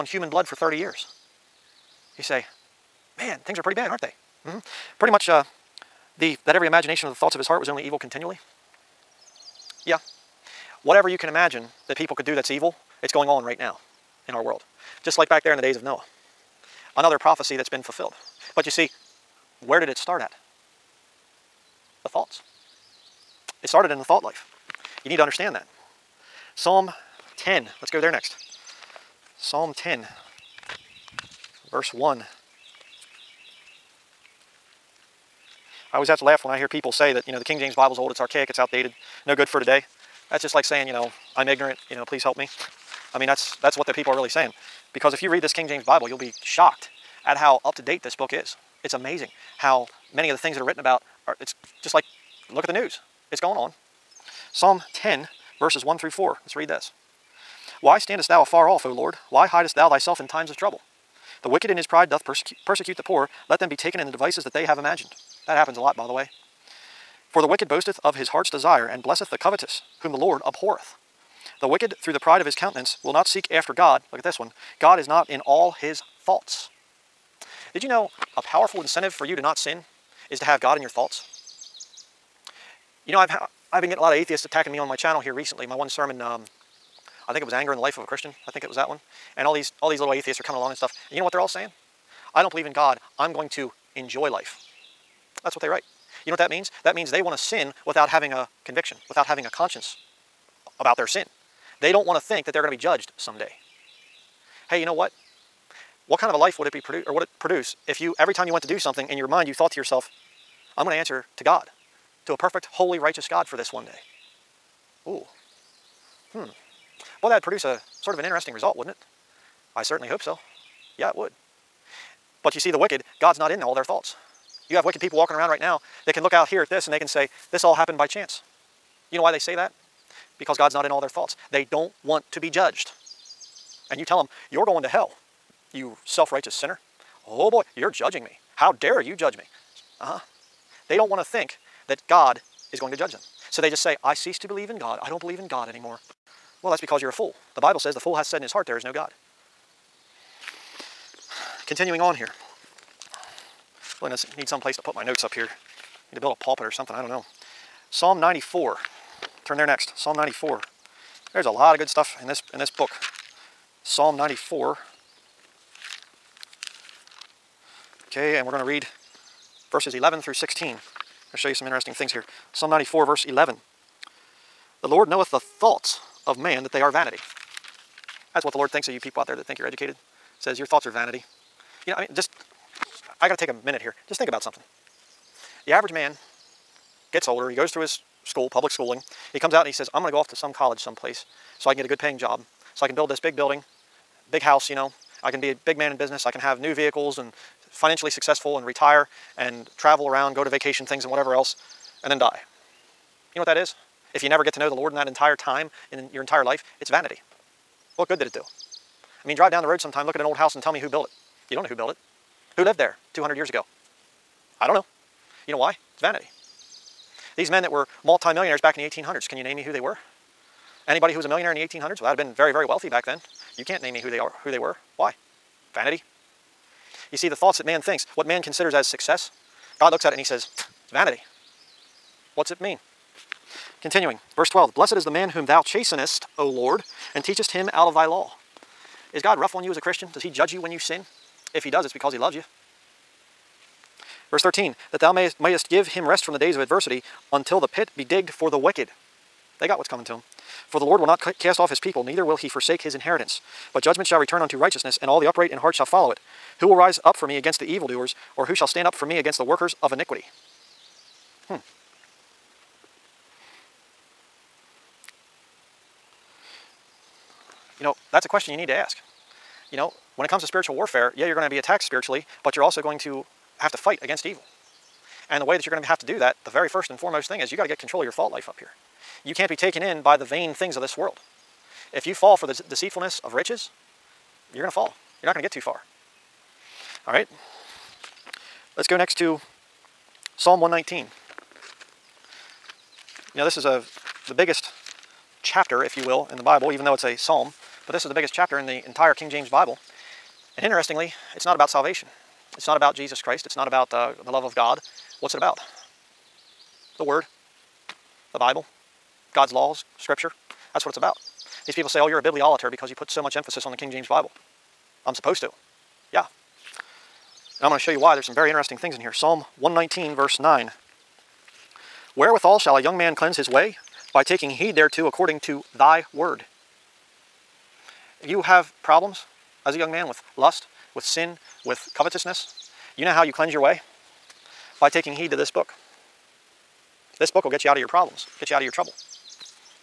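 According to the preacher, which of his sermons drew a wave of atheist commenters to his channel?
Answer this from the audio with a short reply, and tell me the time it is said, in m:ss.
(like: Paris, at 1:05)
Anger in the Life of a Christian, at 1:27.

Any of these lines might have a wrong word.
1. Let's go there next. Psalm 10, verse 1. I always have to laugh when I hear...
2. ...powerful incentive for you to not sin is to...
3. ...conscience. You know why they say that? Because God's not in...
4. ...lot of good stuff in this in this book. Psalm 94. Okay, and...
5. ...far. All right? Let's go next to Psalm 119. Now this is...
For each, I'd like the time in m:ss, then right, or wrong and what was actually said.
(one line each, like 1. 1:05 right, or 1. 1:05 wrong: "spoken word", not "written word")
1. 0:27 right
2. 1:18 right
3. 2:08 wrong: "chance", not "conscience"
4. 2:41 right
5. 4:45 right.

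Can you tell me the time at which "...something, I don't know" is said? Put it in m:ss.
2:36.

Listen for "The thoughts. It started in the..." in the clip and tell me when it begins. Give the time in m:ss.
0:22.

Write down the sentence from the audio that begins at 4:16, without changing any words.
Who will rise up for me against the evildoers, or who shall stand up for me against the workers of iniquity?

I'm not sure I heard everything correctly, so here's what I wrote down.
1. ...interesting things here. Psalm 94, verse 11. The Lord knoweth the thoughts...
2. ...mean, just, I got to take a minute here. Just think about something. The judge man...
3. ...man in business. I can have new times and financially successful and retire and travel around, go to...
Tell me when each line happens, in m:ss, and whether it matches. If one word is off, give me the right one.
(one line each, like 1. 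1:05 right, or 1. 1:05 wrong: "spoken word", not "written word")
1. 2:51 right
2. 3:01 wrong: "average", not "judge"
3. 3:15 wrong: "vehicles", not "times".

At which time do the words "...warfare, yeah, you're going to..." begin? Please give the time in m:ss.
4:30.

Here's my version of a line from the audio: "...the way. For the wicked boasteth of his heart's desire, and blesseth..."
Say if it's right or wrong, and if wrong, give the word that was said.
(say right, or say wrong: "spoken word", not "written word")
right.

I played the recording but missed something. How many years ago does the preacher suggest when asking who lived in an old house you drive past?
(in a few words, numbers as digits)
200.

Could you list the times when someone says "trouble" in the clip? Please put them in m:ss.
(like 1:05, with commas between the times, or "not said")
1:00, 5:38.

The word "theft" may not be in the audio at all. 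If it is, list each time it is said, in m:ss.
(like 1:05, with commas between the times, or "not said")
not said.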